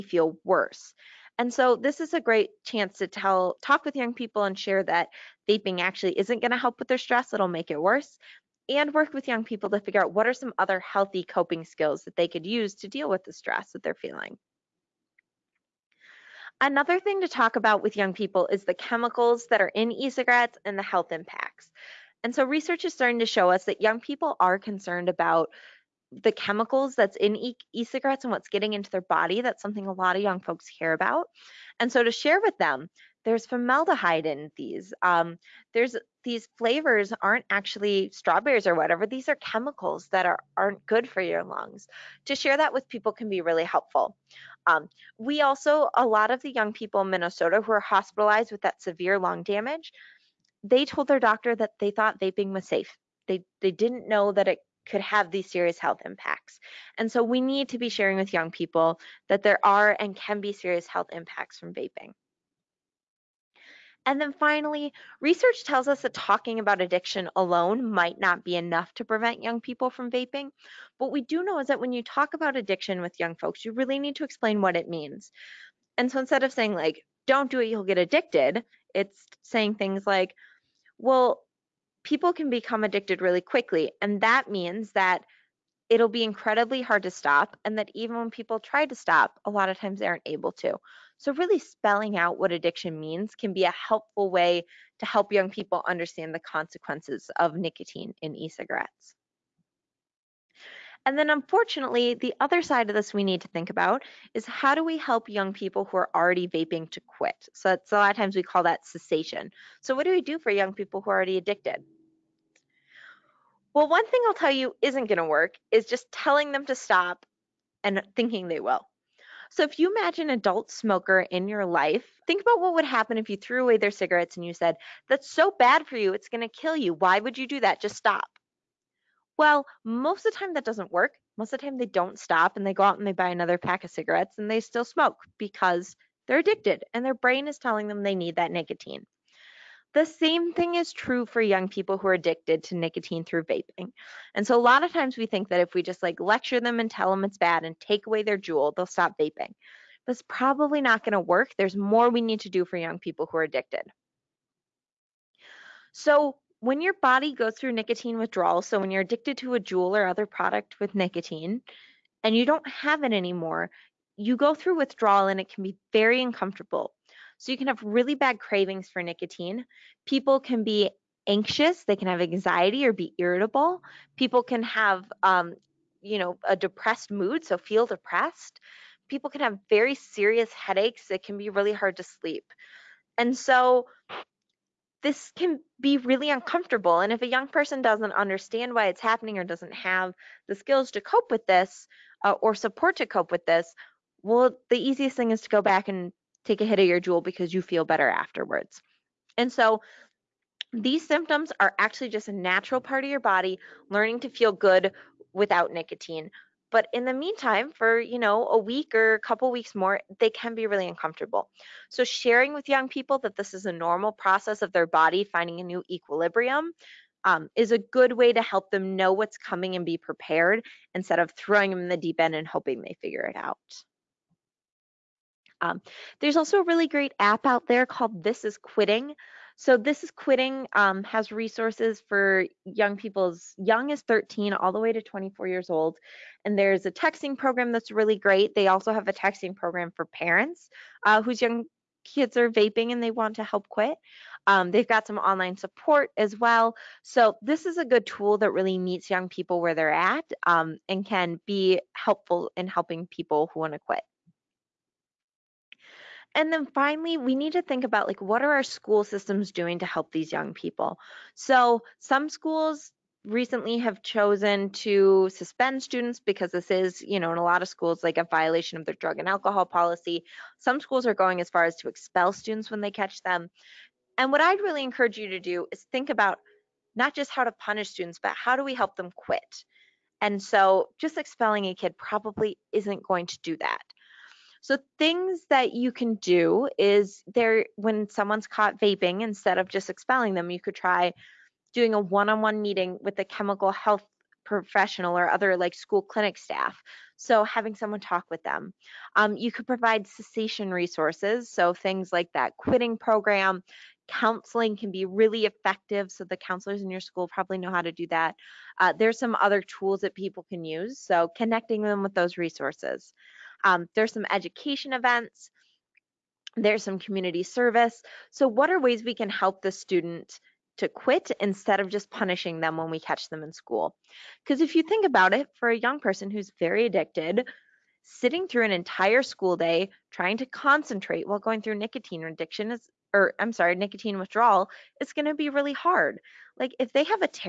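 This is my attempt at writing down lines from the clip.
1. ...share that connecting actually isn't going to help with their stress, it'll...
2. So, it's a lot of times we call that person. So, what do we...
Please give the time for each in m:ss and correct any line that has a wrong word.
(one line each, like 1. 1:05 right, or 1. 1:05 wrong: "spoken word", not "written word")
1. 0:04 wrong: "vaping", not "connecting"
2. 1:47 wrong: "cessation", not "person".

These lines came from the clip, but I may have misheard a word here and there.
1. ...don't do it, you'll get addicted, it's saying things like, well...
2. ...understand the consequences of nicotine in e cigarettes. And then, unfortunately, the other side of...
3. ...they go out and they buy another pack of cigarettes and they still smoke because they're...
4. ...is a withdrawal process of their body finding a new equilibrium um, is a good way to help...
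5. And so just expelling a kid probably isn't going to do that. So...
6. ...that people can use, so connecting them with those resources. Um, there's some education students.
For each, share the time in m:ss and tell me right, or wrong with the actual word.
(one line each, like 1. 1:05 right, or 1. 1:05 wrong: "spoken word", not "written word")
1. 1:17 right
2. 1:35 right
3. 2:12 right
4. 3:33 wrong: "normal", not "withdrawal"
5. 4:40 right
6. 5:10 wrong: "events", not "students".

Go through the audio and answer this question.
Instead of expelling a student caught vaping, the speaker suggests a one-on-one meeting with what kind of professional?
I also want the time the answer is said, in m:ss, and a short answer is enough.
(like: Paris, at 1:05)
Chemical health professional, at 4:53.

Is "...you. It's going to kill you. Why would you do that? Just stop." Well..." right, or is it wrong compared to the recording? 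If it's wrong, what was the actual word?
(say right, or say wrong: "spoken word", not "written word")
right.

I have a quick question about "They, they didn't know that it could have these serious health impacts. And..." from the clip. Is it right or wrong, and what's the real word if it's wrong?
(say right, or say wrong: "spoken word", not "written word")
right.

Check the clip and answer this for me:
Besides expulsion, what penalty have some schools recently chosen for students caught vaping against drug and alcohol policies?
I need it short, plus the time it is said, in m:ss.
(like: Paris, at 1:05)
Suspend, at 4:25.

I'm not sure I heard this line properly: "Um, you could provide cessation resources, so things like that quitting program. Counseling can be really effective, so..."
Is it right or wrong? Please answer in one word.
right.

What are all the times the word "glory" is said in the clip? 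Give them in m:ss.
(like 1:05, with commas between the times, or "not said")
not said.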